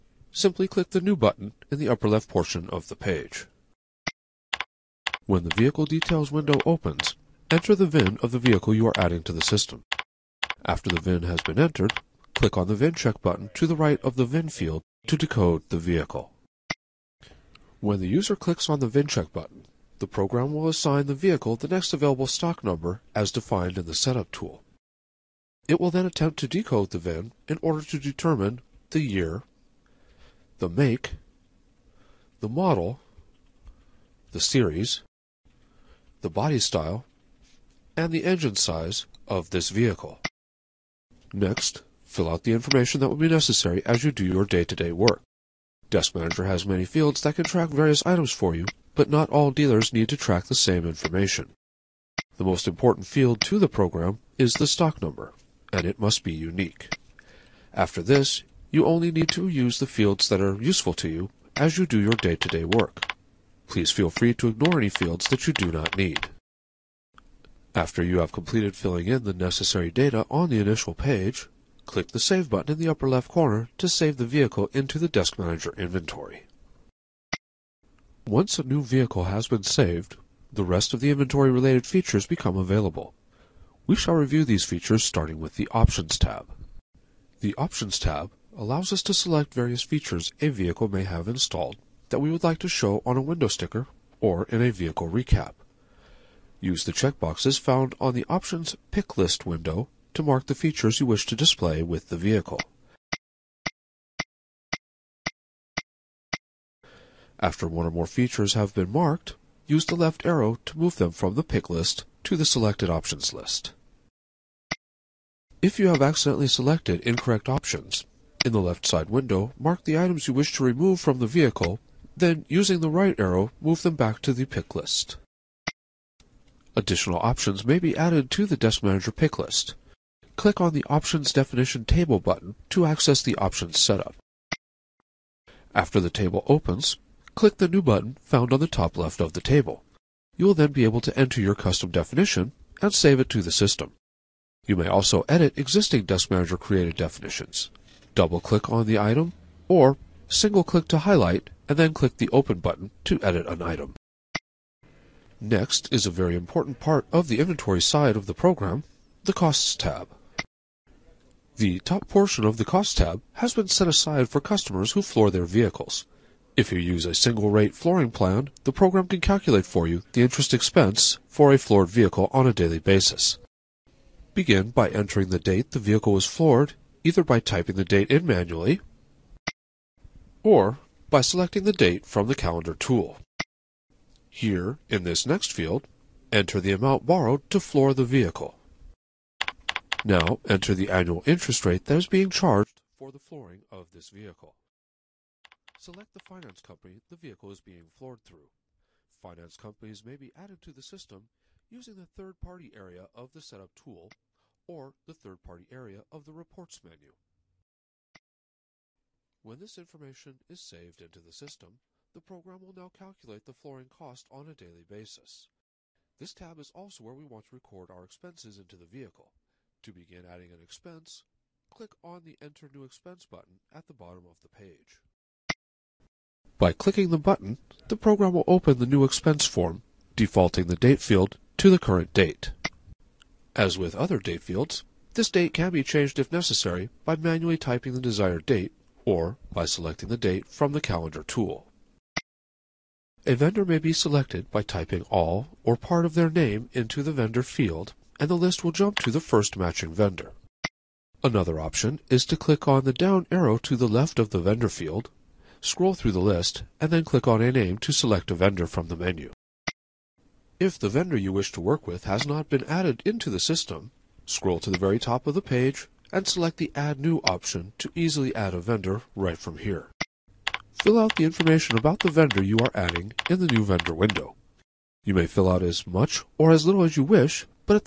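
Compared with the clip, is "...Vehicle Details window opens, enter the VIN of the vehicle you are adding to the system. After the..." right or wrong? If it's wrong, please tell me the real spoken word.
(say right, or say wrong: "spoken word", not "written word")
right.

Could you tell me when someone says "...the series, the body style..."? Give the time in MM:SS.
00:34.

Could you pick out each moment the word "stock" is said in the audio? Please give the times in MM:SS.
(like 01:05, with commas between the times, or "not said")
00:22, 00:54.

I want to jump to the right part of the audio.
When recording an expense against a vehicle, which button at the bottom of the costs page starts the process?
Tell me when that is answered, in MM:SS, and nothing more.
03:42.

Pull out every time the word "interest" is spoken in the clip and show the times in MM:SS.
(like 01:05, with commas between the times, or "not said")
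02:50, 03:11.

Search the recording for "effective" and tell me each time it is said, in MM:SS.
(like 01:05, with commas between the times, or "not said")
not said.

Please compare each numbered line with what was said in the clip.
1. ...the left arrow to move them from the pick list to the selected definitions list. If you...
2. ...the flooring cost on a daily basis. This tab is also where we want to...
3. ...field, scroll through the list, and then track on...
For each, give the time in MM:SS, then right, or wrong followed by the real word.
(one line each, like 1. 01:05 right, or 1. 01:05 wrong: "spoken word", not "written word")
1. 01:49 wrong: "options", not "definitions"
2. 03:33 right
3. 04:14 wrong: "click", not "track".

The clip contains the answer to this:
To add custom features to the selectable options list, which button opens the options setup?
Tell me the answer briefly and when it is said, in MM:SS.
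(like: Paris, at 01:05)
Options Definition Table, at 02:10.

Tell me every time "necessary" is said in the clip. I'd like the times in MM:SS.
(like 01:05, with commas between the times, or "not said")
00:43, 01:09, 03:56.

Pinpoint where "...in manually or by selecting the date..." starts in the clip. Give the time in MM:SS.
02:58.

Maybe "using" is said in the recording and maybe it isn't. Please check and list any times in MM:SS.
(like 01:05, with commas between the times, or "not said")
02:02, 03:21.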